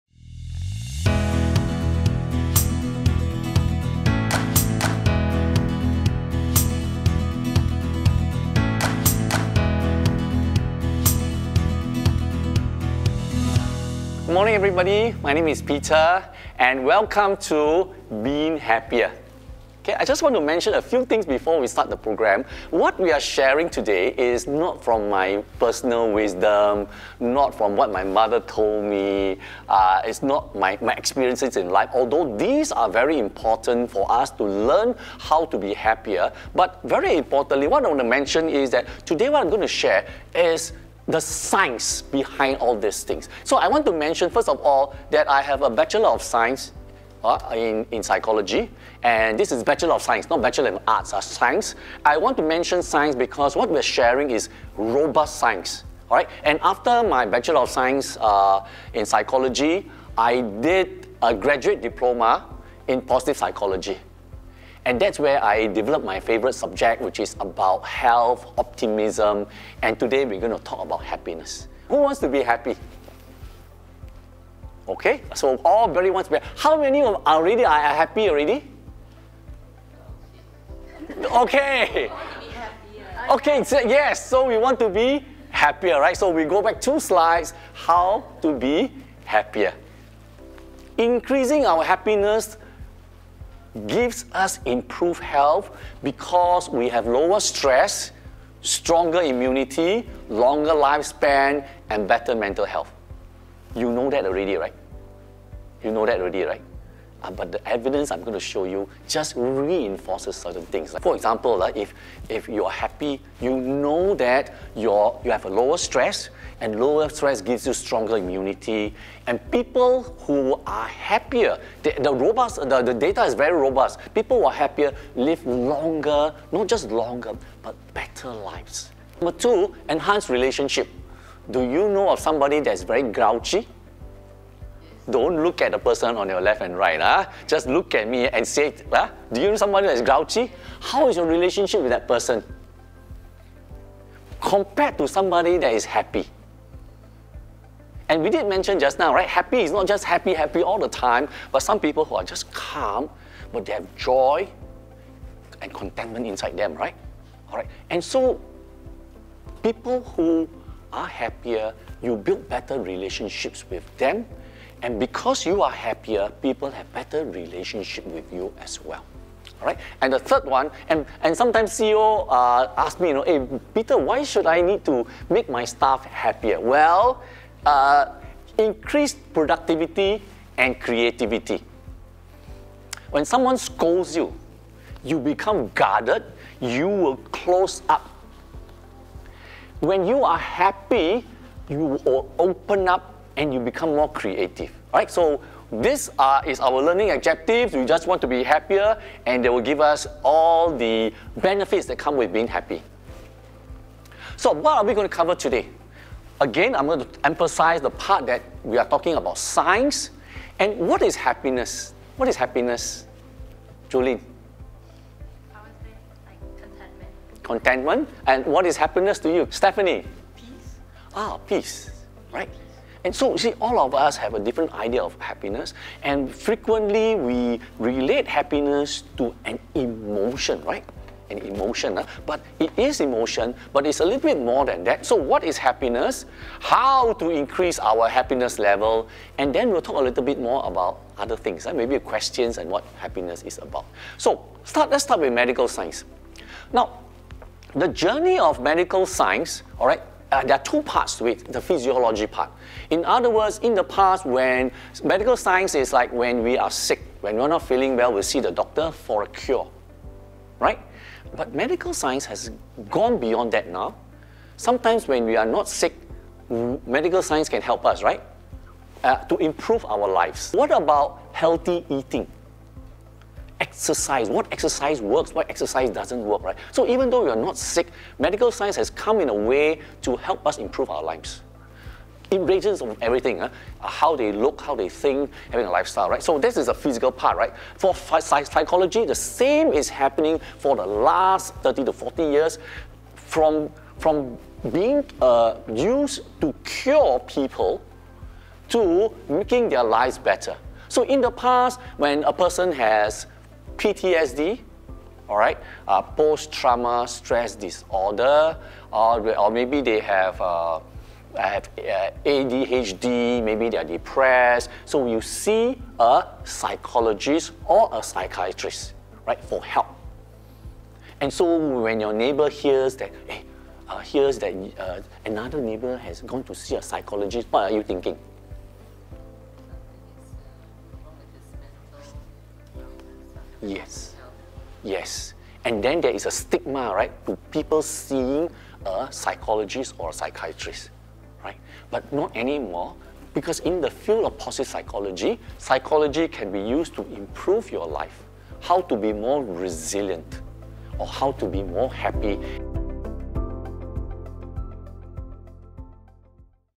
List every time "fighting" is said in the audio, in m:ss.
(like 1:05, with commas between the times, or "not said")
not said.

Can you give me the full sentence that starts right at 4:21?
But medical science has gone beyond that now.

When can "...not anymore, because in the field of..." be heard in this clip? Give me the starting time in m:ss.
5:42.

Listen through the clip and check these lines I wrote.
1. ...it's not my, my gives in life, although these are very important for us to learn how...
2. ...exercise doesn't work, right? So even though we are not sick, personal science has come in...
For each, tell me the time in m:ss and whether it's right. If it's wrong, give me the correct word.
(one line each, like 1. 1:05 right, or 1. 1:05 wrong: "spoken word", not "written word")
1. 0:30 wrong: "experiences", not "gives"
2. 4:35 wrong: "medical", not "personal".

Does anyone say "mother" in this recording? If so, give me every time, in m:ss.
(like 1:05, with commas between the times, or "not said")
0:28.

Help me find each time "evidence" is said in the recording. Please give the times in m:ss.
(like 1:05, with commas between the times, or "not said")
1:47.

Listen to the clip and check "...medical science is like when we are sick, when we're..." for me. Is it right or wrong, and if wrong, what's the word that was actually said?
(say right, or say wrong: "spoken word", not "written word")
right.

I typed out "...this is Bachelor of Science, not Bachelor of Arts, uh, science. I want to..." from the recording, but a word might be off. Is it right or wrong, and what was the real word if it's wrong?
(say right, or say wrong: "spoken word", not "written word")
right.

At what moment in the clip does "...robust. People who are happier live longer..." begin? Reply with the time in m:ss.
2:03.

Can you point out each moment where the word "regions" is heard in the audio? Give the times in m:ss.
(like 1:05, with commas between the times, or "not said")
4:42.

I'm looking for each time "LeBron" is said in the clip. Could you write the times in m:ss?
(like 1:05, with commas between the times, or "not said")
not said.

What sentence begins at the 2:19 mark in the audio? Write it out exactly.
Ah, do you know someone that is grouchy?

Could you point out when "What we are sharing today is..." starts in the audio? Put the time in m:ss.
0:22.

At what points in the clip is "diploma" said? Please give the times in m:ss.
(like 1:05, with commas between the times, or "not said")
1:01.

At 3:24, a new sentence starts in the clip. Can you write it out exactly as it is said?
So what are we going to cover today?